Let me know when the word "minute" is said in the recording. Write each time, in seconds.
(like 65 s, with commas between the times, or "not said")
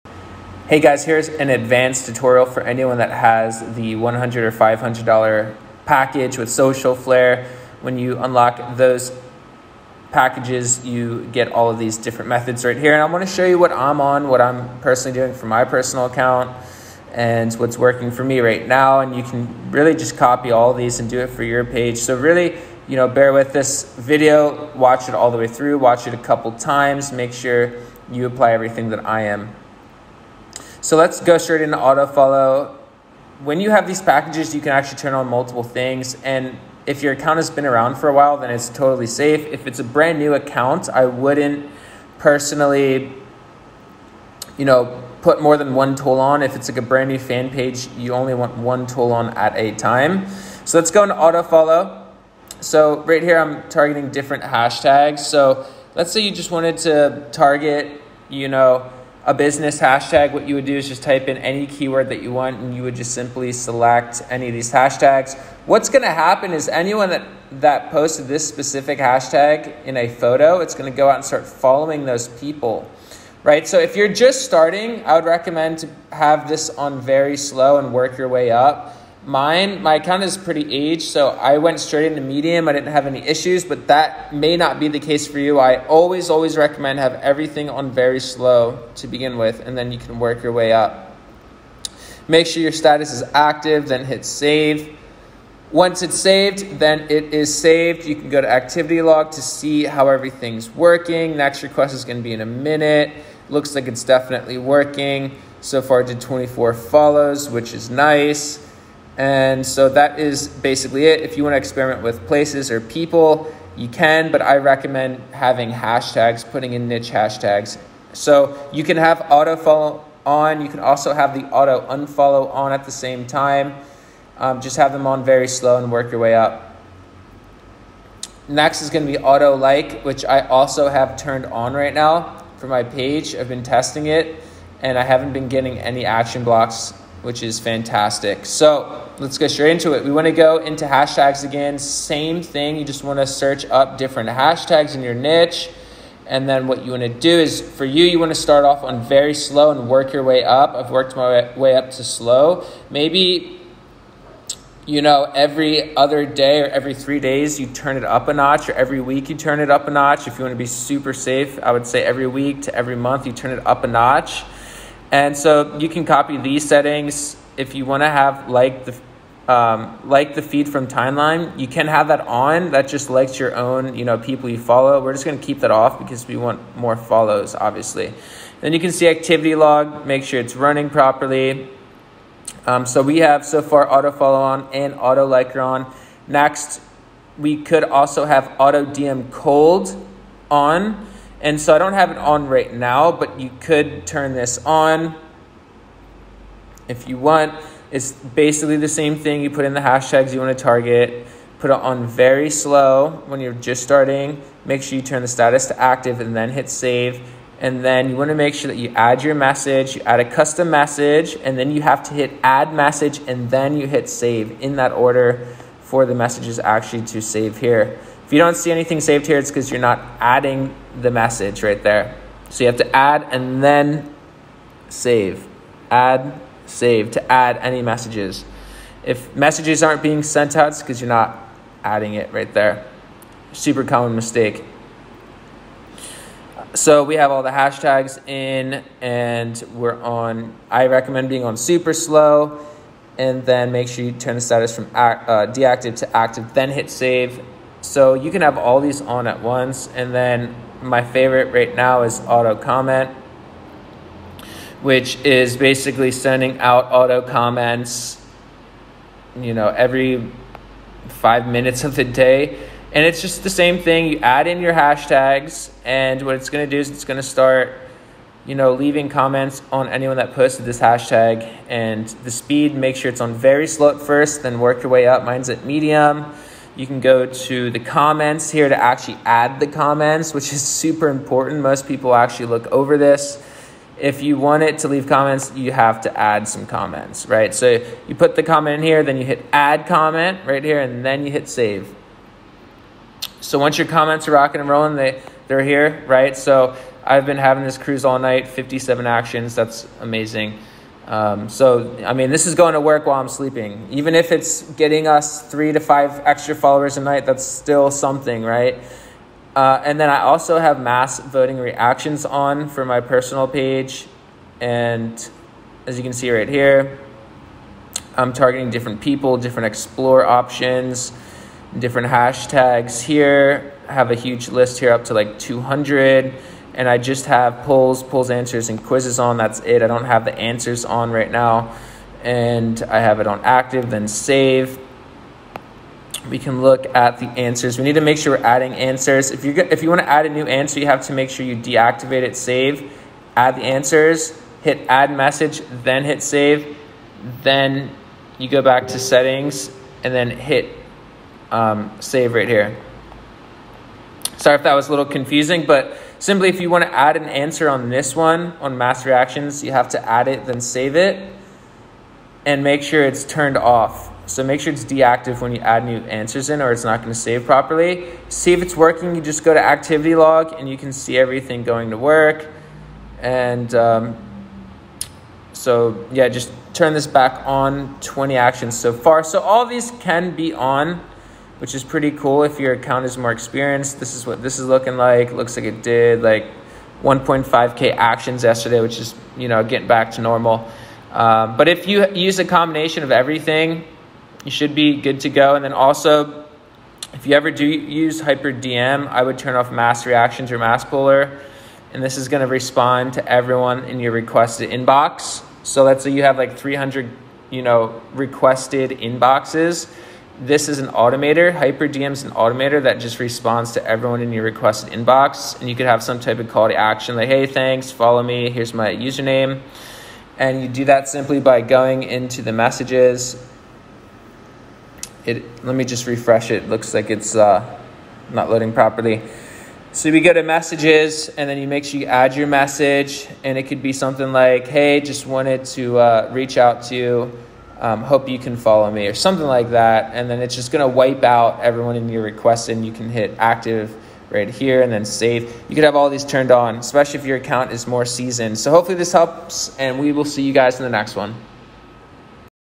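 102 s, 261 s.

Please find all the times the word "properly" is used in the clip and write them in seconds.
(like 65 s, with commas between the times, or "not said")
180 s, 367 s, 428 s.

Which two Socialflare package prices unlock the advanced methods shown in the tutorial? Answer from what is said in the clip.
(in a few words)
$100 or $500.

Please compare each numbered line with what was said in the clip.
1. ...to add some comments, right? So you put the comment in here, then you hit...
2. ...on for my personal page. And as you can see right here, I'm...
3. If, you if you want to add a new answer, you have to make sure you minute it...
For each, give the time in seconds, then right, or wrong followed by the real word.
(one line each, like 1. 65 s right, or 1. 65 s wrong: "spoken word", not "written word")
1. 286 s right
2. 312 s right
3. 339 s wrong: "deactivate", not "minute".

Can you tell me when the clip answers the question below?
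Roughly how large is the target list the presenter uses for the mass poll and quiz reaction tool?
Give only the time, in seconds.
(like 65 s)
325 s.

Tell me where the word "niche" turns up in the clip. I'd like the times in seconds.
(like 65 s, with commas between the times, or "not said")
116 s, 145 s.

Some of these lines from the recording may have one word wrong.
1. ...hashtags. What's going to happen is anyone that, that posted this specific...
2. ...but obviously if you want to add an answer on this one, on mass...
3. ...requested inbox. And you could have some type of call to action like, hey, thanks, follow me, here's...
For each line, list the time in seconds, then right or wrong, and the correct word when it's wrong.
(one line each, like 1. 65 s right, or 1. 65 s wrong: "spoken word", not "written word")
1. 64 s right
2. 355 s wrong: "simply", not "obviously"
3. 414 s right.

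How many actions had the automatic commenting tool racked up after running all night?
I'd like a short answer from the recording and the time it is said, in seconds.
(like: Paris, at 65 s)
57, at 298 s.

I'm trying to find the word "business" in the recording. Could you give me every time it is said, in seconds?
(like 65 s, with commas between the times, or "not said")
59 s.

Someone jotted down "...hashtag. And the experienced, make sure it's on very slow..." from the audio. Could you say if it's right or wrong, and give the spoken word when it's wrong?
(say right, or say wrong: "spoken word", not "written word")
wrong: "speed", not "experienced".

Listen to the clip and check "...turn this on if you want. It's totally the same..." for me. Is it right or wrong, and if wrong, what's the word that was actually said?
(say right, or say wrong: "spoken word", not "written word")
wrong: "basically", not "totally".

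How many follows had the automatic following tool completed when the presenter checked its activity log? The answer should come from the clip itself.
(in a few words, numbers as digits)
24.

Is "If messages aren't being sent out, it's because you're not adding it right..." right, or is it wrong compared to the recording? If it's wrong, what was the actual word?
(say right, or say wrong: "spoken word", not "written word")
right.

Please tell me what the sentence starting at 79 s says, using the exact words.
Mine, my account is pretty aged, so I went straight into Medium.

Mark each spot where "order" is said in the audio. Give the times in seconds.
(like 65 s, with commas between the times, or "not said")
214 s.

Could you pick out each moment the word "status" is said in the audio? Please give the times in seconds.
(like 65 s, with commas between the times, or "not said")
92 s, 205 s, 244 s.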